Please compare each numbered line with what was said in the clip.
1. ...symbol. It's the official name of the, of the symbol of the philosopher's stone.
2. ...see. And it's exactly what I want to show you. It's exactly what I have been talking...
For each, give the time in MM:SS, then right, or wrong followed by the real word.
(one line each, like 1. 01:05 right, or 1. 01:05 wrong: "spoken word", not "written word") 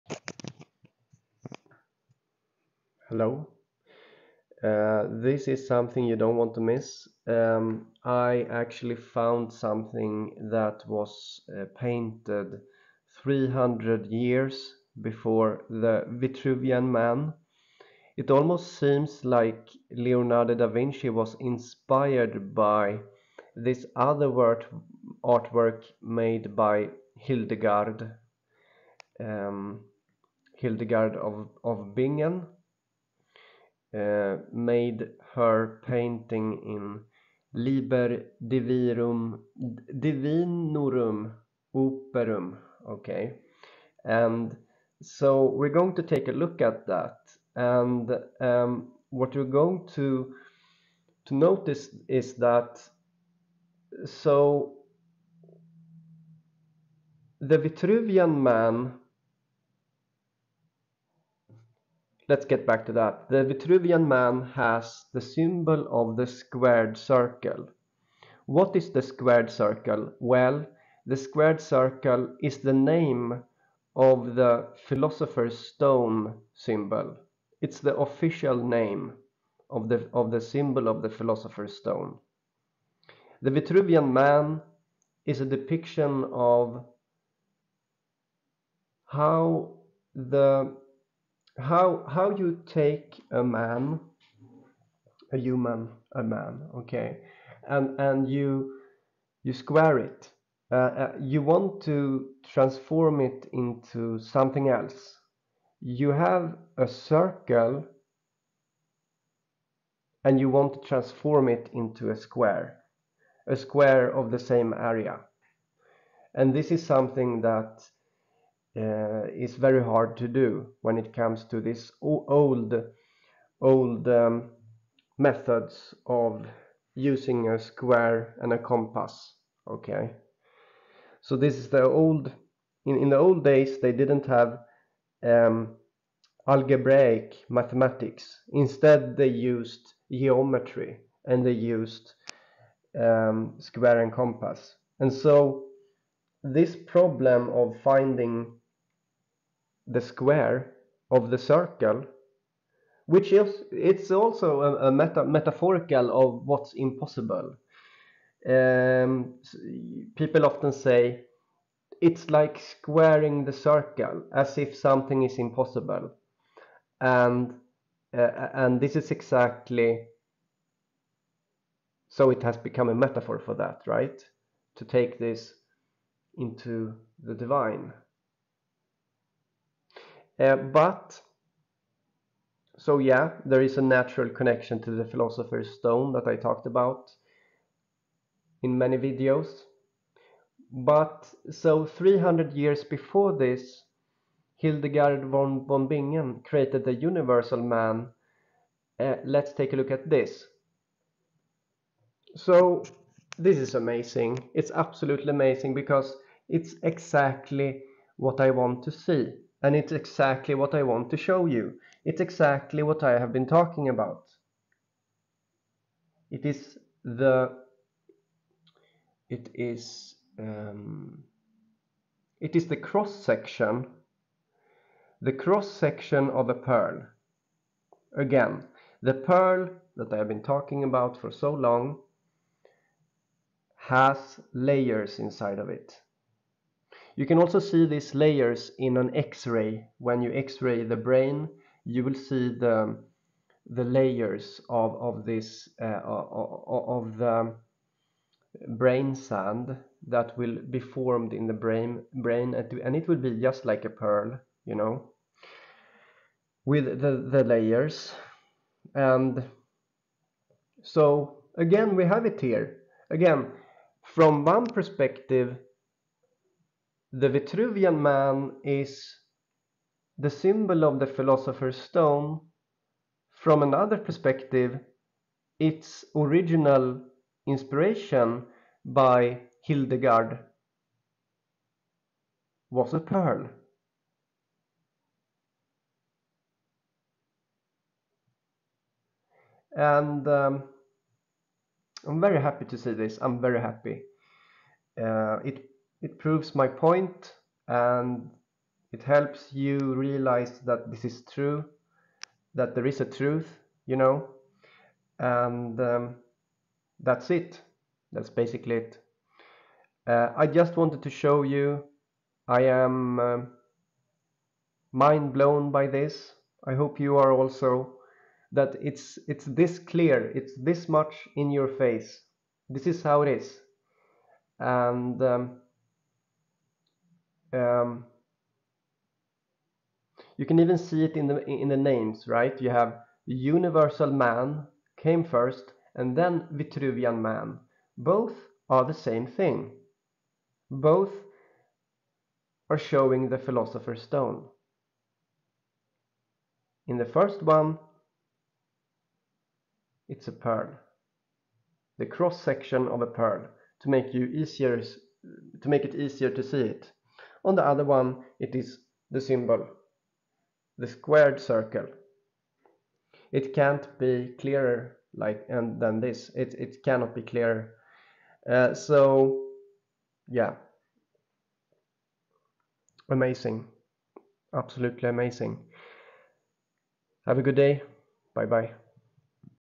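1. 01:16 right
2. 03:28 right.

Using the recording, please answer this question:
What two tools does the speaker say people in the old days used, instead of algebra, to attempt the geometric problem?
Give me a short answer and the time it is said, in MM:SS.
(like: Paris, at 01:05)
square and compass, at 02:23.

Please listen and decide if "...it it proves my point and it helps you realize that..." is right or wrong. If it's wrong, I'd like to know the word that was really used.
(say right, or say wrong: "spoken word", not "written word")
right.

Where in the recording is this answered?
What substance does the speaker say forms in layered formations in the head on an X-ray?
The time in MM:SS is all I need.
04:08.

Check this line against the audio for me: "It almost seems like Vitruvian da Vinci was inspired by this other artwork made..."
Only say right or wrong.
wrong.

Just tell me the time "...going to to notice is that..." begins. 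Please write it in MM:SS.
00:49.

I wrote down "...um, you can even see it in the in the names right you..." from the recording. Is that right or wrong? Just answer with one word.
right.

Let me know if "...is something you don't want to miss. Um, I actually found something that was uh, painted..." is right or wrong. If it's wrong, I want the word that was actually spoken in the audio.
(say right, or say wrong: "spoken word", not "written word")
right.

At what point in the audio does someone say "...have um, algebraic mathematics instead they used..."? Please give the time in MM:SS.
02:14.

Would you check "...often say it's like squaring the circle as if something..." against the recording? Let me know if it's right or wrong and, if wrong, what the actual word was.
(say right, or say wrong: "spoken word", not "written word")
right.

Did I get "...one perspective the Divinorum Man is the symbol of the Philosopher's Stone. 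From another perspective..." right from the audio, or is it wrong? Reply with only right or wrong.
wrong.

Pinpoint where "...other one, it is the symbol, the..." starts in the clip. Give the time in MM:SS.
05:57.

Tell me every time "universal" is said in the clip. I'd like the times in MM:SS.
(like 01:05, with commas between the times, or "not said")
03:16, 05:33.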